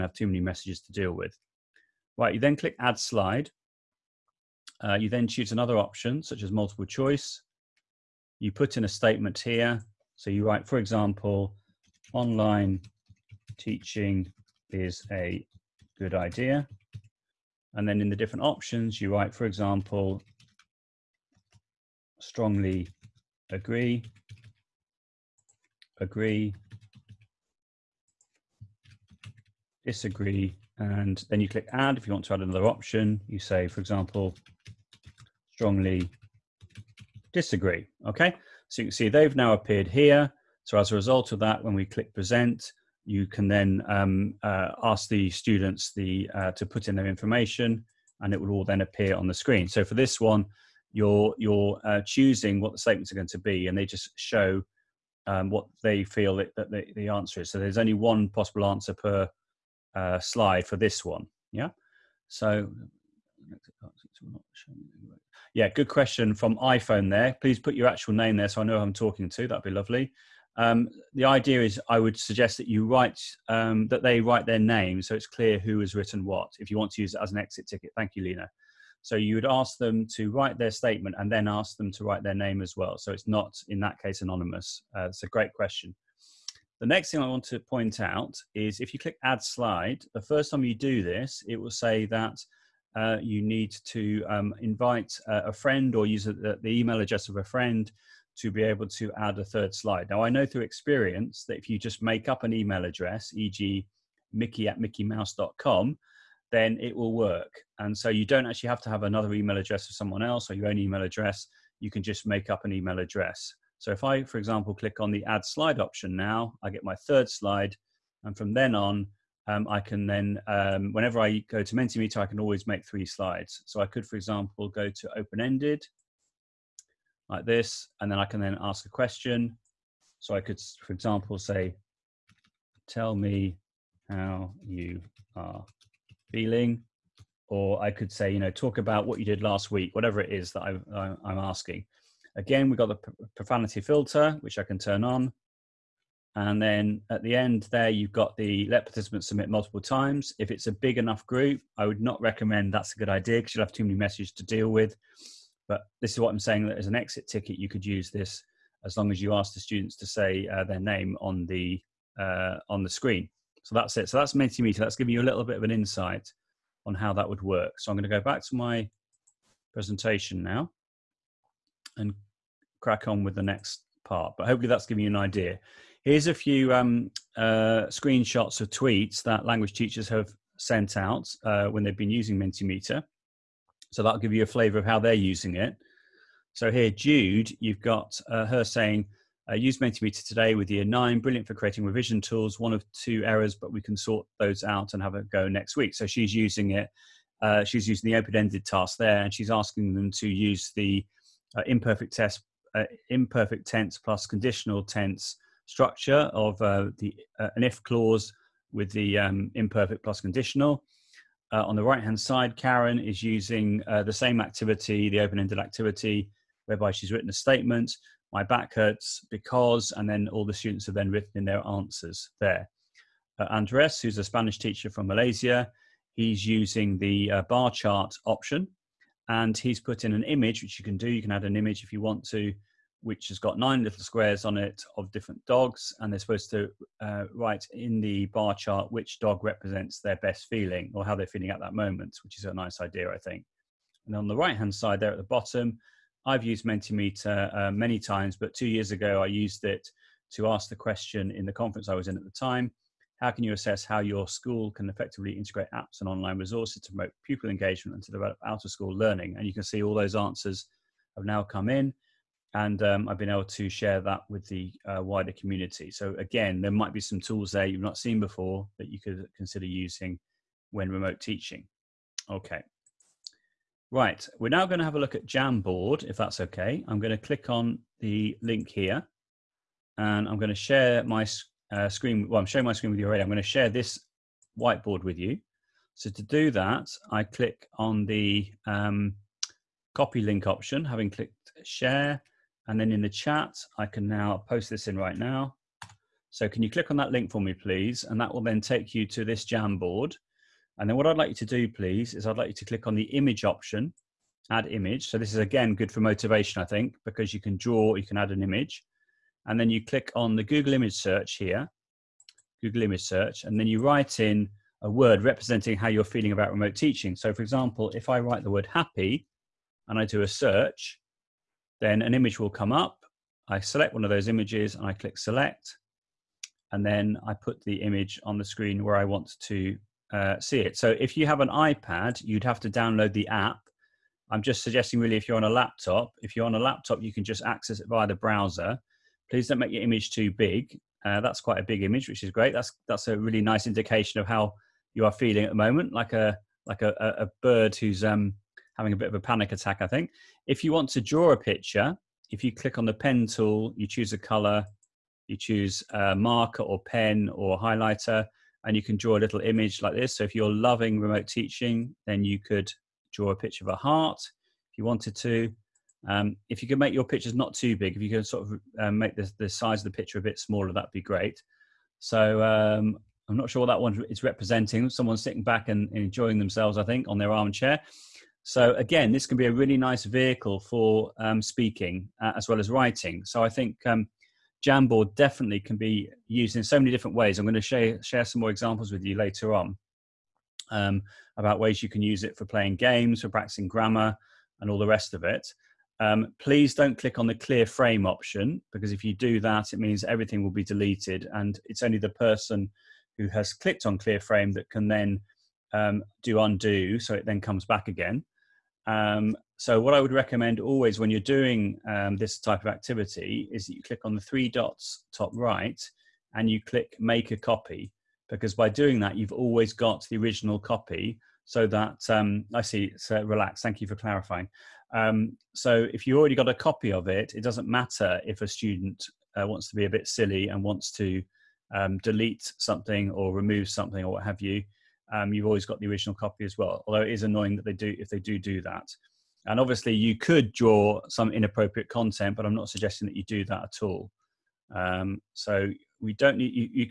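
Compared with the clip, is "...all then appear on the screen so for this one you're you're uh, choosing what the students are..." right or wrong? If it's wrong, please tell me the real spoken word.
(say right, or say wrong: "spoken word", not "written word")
wrong: "statements", not "students".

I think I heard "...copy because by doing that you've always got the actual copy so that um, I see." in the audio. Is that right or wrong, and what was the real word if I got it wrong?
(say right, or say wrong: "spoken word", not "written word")
wrong: "original", not "actual".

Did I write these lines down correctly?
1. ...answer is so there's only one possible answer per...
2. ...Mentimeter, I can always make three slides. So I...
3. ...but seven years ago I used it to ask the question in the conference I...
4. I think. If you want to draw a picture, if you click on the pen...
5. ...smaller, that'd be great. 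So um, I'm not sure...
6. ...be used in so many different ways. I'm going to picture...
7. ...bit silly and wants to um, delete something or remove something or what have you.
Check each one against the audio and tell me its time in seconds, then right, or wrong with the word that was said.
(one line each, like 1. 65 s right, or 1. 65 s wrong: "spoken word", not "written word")
1. 57 s right
2. 121 s right
3. 248 s wrong: "two", not "seven"
4. 349 s right
5. 370 s right
6. 385 s wrong: "share", not "picture"
7. 429 s right.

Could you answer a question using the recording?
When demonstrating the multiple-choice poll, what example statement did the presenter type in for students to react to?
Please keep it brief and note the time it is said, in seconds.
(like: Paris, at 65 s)
Online teaching is a good idea, at 12 s.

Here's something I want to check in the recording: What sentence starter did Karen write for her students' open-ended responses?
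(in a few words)
My back hurts because.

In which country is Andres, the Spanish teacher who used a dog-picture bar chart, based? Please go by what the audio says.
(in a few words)
Malaysia.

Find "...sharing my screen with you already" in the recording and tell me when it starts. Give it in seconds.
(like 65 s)
282 s.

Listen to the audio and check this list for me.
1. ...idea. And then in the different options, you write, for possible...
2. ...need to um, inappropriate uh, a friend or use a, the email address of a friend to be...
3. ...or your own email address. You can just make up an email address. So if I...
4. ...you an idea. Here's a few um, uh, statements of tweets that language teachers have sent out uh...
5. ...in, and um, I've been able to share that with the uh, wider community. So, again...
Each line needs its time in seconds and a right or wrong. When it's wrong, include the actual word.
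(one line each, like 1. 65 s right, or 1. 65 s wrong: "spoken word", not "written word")
1. 16 s wrong: "example", not "possible"
2. 93 s wrong: "invite", not "inappropriate"
3. 110 s right
4. 175 s wrong: "screenshots", not "statements"
5. 261 s right.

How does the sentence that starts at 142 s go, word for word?
Again, we've got the profanity filter, which I can turn on.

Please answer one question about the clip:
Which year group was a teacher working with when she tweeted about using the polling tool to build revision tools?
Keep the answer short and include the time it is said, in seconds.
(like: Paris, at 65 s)
Year 9, at 190 s.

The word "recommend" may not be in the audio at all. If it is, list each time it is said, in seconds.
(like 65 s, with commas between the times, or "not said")
152 s, 410 s.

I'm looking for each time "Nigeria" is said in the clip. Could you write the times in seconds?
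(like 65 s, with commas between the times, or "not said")
not said.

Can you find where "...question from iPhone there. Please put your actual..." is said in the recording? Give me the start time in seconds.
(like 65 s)
65 s.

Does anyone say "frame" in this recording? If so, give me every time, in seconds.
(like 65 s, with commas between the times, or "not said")
397 s, 404 s.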